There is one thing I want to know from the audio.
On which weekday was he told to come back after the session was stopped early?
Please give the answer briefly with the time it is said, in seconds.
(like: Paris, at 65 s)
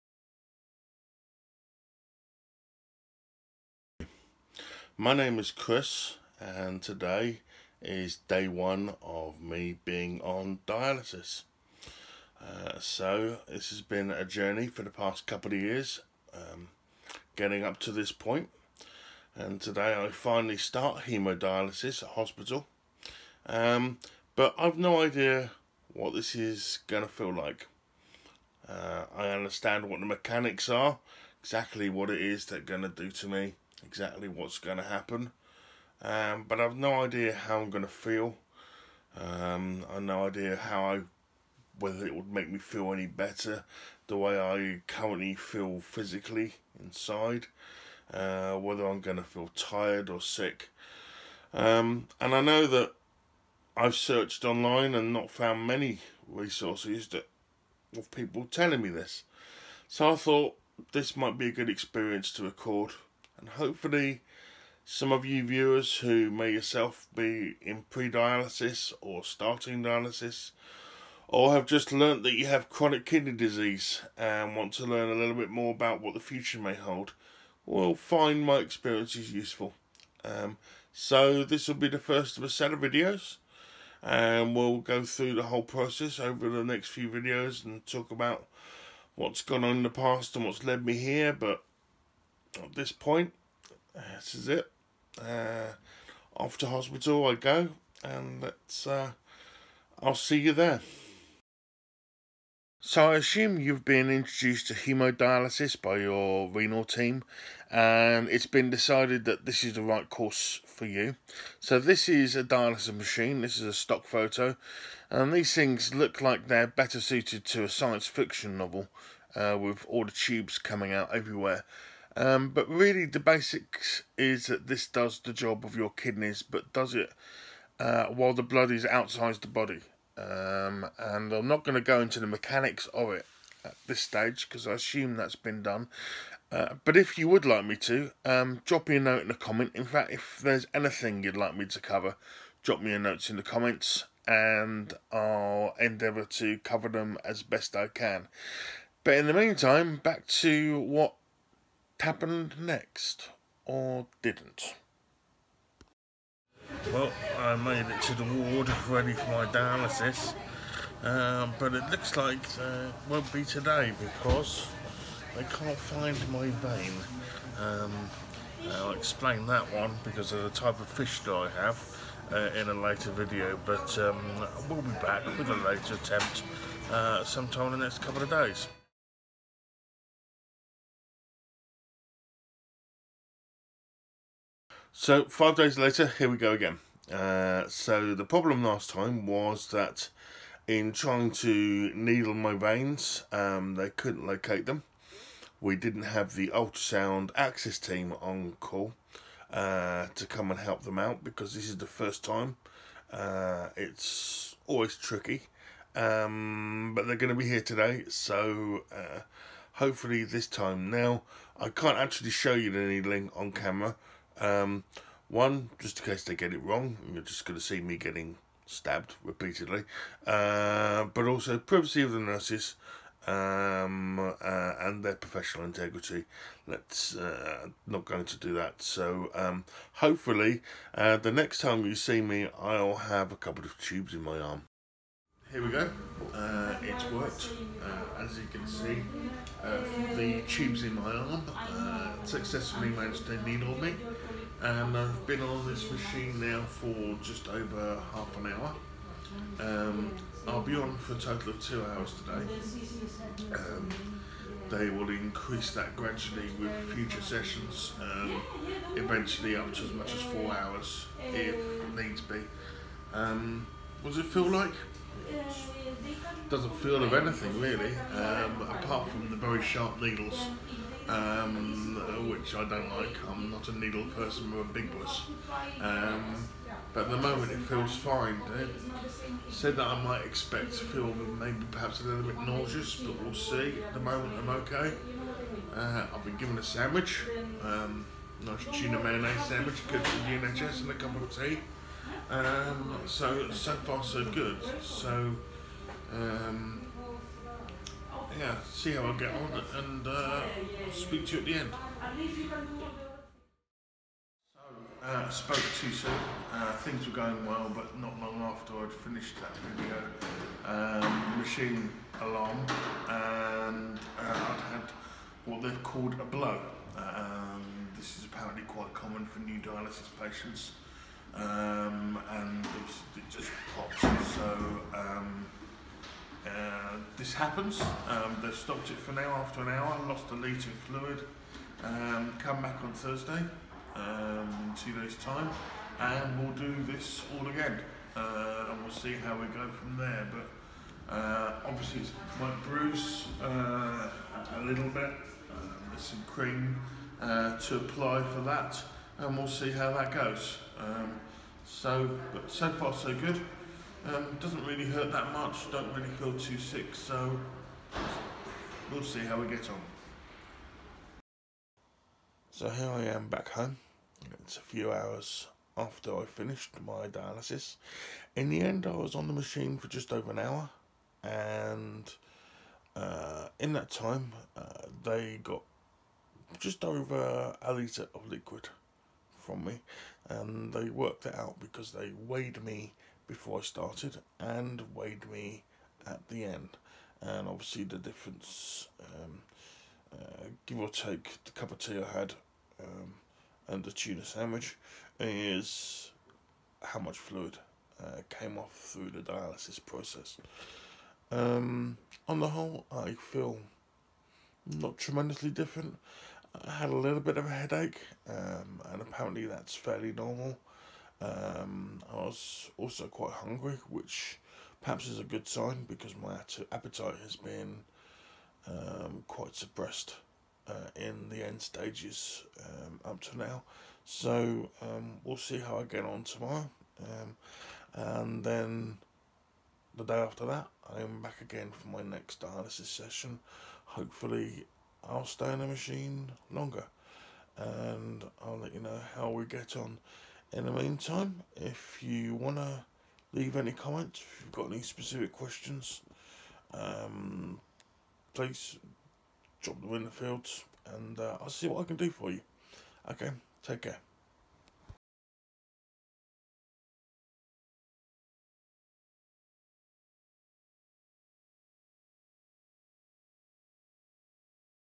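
Thursday, at 332 s.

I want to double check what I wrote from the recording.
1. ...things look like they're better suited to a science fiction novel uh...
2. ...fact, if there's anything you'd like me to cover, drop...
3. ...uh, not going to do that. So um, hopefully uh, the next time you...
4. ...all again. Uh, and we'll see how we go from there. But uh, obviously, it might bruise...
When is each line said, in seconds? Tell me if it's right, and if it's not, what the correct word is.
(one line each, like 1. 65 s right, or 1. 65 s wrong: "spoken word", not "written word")
1. 115 s right
2. 139 s right
3. 227 s right
4. 337 s right.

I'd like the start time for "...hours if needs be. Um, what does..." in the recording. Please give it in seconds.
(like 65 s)
260 s.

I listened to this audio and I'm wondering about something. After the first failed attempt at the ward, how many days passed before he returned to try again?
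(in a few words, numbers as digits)
5.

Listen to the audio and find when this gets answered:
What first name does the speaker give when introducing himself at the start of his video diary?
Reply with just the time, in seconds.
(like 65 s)
5 s.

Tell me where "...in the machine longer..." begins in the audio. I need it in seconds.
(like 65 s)
435 s.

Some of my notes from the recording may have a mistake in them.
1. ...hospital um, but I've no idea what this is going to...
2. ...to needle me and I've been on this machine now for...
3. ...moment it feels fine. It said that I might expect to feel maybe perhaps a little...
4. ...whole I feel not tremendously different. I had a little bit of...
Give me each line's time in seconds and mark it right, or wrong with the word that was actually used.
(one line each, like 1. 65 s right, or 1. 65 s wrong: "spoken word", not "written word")
1. 22 s right
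2. 243 s right
3. 277 s right
4. 402 s right.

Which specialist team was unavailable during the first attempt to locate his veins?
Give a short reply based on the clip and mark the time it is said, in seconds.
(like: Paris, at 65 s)
Ultrasound access team, at 196 s.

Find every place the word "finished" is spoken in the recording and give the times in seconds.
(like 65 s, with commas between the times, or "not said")
308 s, 366 s.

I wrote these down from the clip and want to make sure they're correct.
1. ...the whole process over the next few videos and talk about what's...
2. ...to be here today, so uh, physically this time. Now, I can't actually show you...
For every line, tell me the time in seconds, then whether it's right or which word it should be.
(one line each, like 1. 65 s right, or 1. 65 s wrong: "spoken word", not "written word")
1. 85 s right
2. 207 s wrong: "hopefully", not "physically".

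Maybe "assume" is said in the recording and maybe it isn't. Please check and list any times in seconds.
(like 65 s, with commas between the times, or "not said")
103 s, 134 s.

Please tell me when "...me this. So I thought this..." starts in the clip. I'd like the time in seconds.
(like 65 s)
58 s.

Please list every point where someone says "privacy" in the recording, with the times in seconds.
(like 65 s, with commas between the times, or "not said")
221 s.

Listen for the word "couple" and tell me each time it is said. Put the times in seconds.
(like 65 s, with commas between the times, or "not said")
15 s, 178 s, 233 s.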